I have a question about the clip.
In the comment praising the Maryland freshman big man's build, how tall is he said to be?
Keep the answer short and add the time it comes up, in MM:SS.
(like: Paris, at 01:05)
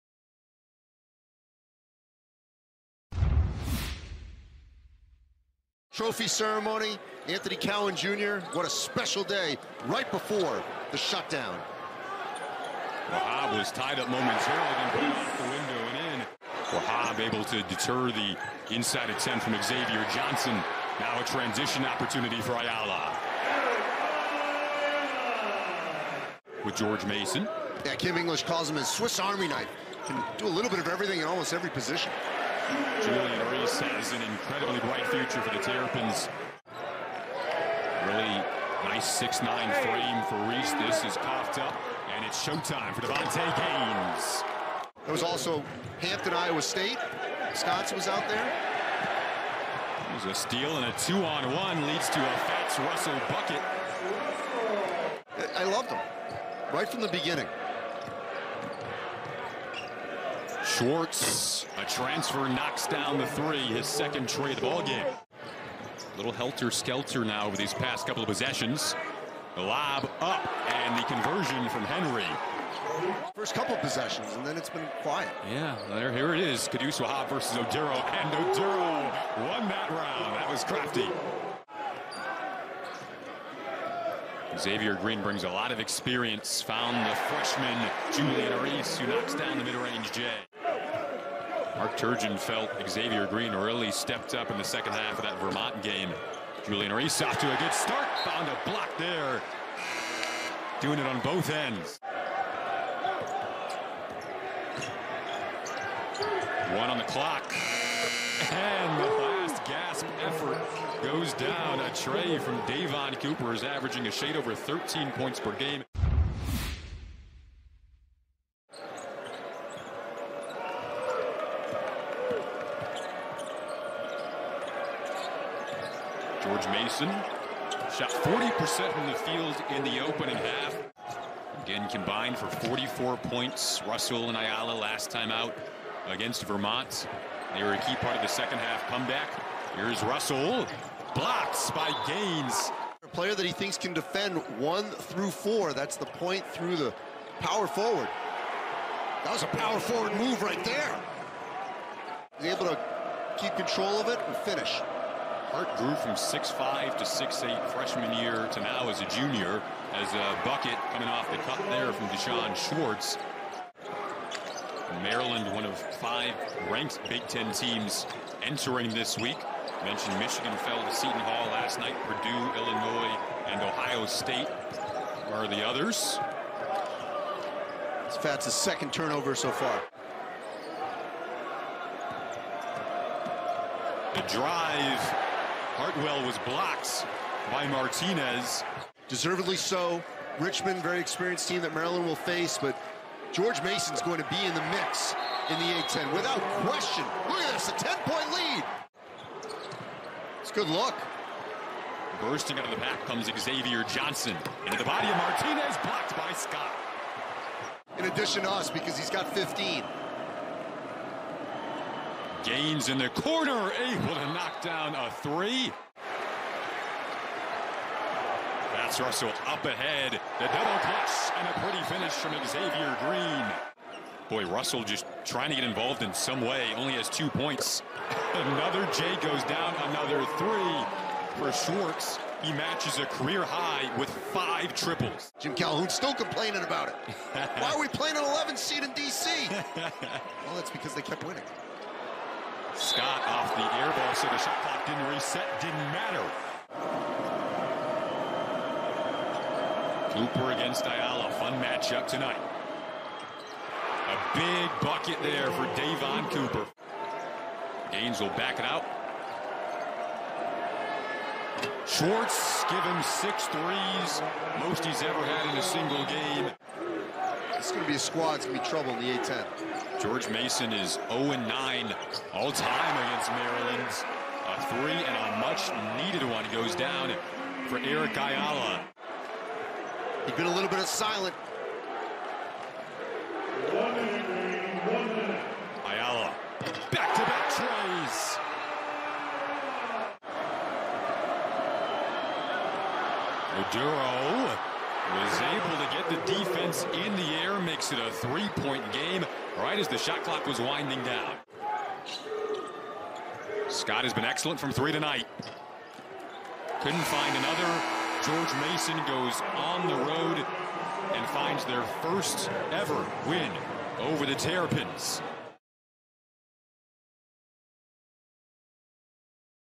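6'9, at 00:39.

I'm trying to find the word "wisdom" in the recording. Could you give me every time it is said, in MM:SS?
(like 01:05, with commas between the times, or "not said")
not said.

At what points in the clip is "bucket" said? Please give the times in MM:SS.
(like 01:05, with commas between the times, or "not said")
00:53, 02:40, 04:14.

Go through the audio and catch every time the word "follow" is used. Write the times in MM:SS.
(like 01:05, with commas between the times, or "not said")
not said.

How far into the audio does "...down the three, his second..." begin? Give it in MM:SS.
01:02.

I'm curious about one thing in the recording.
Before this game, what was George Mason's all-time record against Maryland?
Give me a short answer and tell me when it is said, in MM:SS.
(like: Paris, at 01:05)
0-9, at 04:31.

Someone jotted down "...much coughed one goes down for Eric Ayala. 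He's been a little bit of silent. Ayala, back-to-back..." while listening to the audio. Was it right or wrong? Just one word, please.
wrong.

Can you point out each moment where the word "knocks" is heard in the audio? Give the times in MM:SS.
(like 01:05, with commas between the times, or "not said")
01:02, 01:29, 03:34.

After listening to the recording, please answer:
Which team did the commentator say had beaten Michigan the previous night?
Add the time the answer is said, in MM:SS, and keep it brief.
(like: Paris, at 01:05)
Seton Hall, at 02:50.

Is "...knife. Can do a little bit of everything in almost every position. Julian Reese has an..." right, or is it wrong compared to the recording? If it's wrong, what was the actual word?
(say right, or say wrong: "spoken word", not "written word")
right.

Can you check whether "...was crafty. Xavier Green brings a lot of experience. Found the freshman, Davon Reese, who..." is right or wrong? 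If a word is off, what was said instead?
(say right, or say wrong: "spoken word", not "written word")
wrong: "Julian", not "Davon".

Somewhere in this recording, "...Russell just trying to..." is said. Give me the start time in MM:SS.
03:44.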